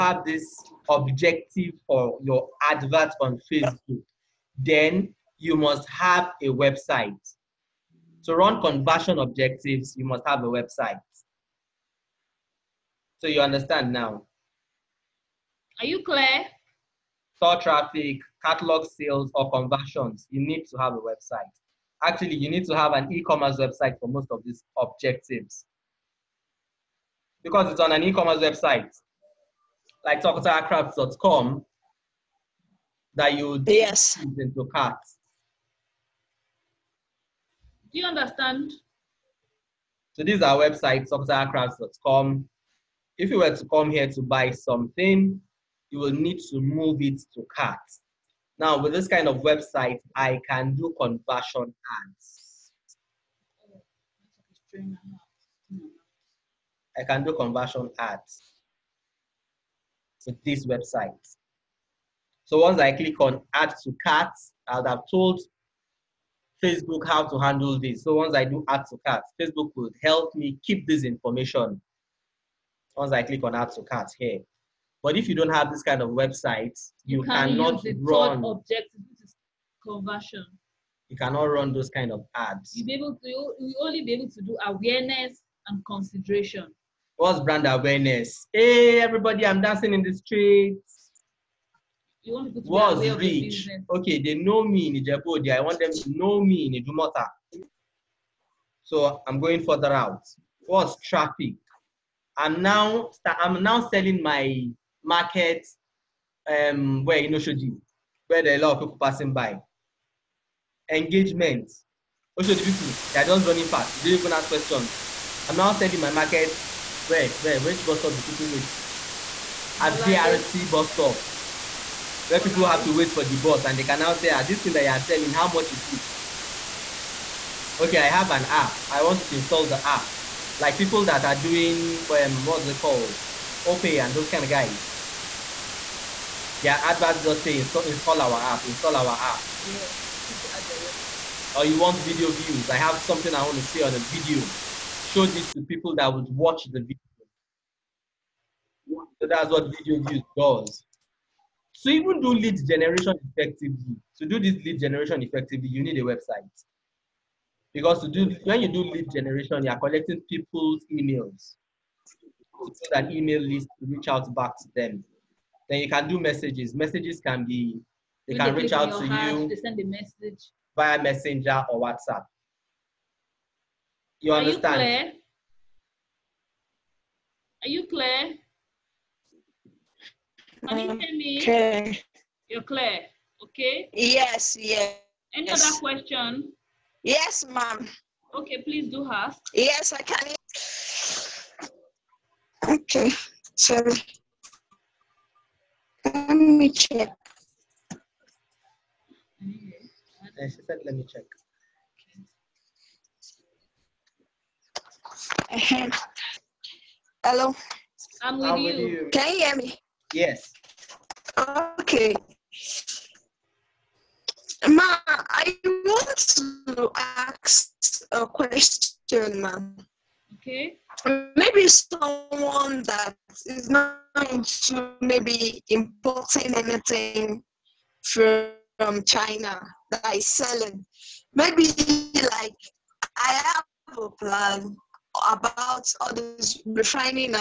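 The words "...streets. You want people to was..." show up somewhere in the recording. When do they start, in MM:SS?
01:30.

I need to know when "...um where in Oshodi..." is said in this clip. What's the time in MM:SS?
01:46.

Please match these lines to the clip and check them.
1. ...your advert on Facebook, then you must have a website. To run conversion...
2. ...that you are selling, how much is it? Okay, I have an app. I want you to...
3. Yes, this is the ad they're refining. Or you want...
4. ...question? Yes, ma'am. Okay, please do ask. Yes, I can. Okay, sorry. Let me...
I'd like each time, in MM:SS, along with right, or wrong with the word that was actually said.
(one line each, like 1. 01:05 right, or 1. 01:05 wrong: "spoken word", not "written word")
1. 00:02 right
2. 02:04 right
3. 02:19 wrong: "running", not "refining"
4. 03:05 right.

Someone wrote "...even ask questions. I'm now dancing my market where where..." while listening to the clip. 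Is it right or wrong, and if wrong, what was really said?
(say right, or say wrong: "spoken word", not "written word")
wrong: "selling", not "dancing".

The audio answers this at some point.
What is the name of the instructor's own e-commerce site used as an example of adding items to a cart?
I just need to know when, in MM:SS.
00:41.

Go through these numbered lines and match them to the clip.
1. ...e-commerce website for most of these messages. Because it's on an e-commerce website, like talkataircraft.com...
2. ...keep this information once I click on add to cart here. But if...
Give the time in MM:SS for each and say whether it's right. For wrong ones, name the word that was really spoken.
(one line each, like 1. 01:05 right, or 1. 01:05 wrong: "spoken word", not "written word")
1. 00:23 wrong: "objectives", not "messages"
2. 01:10 right.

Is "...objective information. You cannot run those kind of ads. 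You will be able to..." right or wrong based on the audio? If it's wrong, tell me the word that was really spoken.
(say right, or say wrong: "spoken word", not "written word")
wrong: "conversion", not "information".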